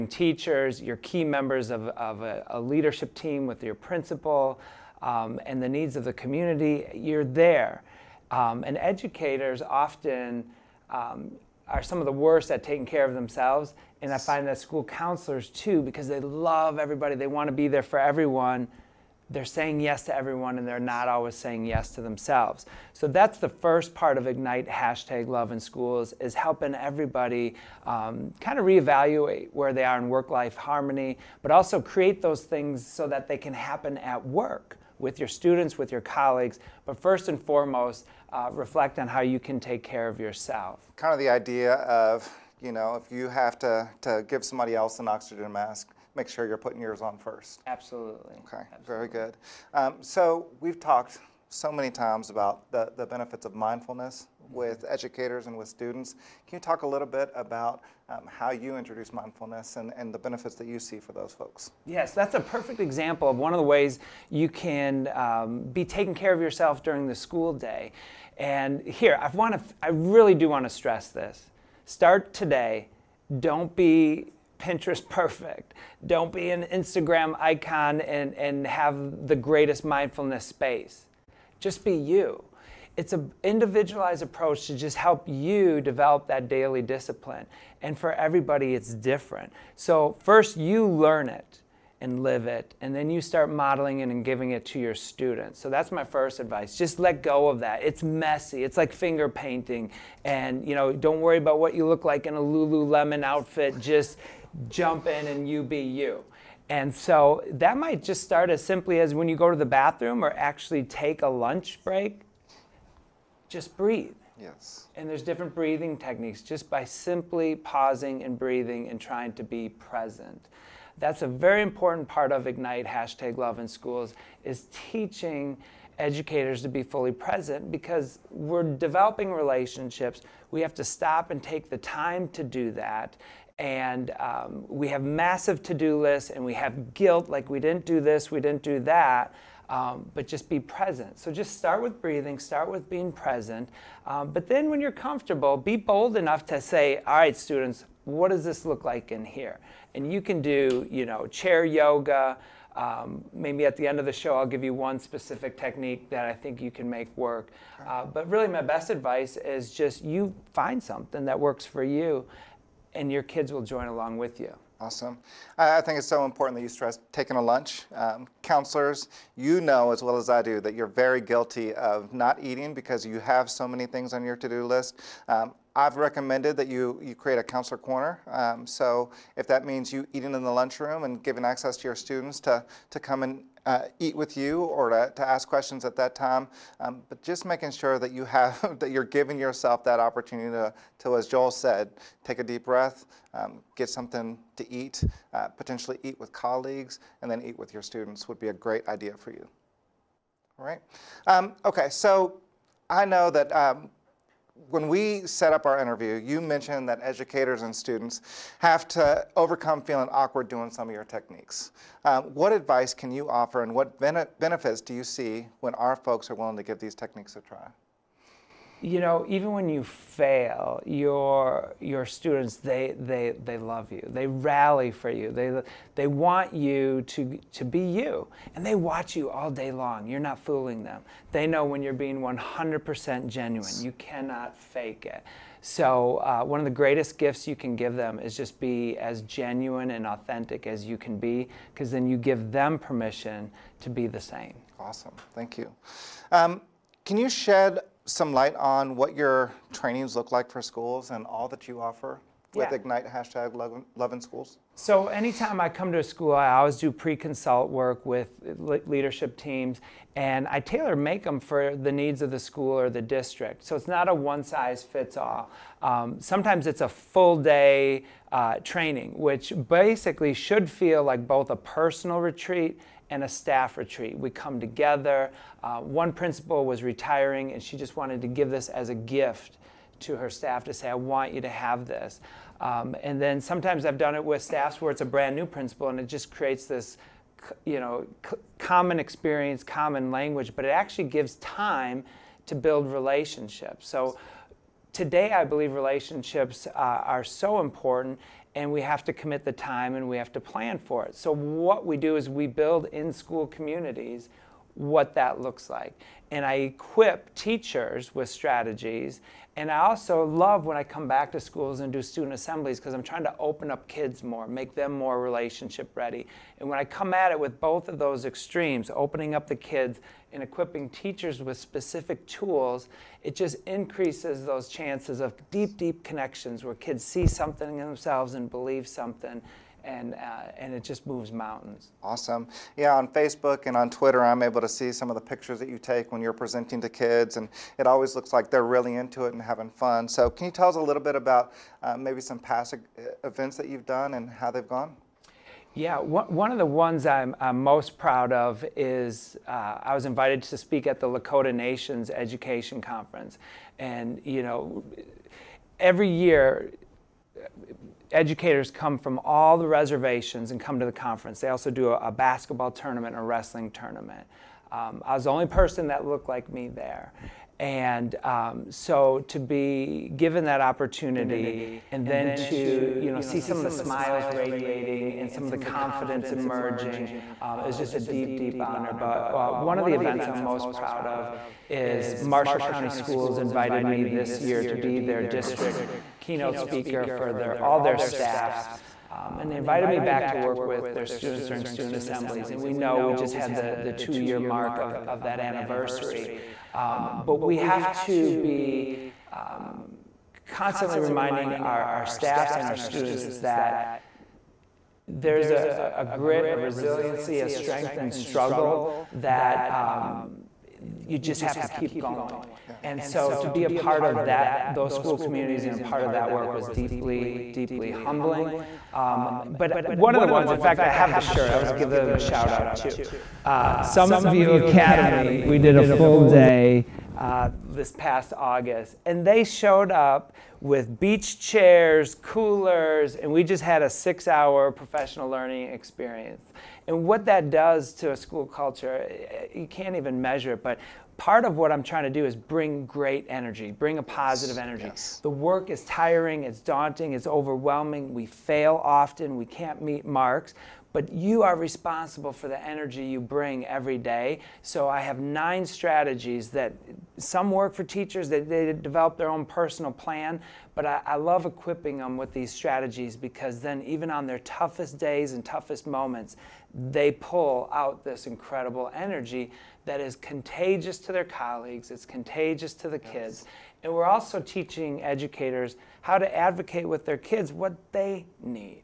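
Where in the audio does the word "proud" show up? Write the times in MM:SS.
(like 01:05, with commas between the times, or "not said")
05:47, 06:20.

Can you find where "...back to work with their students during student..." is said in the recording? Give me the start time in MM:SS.
06:30.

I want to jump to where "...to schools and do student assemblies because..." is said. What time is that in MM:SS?
05:11.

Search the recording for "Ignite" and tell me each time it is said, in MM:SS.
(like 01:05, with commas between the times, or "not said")
00:24, 02:02, 04:12.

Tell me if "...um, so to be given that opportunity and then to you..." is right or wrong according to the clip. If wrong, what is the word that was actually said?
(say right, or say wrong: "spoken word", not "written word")
right.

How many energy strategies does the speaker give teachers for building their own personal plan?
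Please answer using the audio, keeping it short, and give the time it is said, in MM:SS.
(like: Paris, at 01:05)
9, at 07:35.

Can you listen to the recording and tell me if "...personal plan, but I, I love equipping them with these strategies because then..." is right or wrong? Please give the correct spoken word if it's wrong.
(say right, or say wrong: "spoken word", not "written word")
right.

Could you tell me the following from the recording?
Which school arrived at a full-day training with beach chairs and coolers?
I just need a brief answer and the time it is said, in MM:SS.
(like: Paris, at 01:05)
Summit View Academy, at 07:03.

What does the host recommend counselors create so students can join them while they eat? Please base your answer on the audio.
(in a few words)
A counselor corner.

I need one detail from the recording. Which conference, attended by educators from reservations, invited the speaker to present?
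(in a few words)
Lakota Nations Education Conference.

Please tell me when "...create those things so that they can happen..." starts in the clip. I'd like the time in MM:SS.
00:31.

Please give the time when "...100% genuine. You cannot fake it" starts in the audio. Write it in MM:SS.
03:52.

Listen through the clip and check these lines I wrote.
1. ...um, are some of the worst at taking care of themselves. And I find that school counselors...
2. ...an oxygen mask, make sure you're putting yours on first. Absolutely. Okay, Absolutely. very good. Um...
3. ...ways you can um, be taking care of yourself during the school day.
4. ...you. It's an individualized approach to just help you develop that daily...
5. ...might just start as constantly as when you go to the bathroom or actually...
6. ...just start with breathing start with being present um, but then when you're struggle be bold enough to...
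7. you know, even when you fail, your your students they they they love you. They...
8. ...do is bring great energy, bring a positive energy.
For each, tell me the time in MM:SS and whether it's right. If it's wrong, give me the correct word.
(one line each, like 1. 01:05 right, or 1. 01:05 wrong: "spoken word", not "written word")
1. 00:10 right
2. 00:44 right
3. 01:03 right
4. 01:21 right
5. 01:47 wrong: "simply", not "constantly"
6. 02:21 wrong: "comfortable", not "struggle"
7. 03:38 right
8. 07:22 right.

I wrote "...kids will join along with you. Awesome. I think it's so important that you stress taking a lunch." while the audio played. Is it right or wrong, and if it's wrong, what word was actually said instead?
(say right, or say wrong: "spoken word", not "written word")
right.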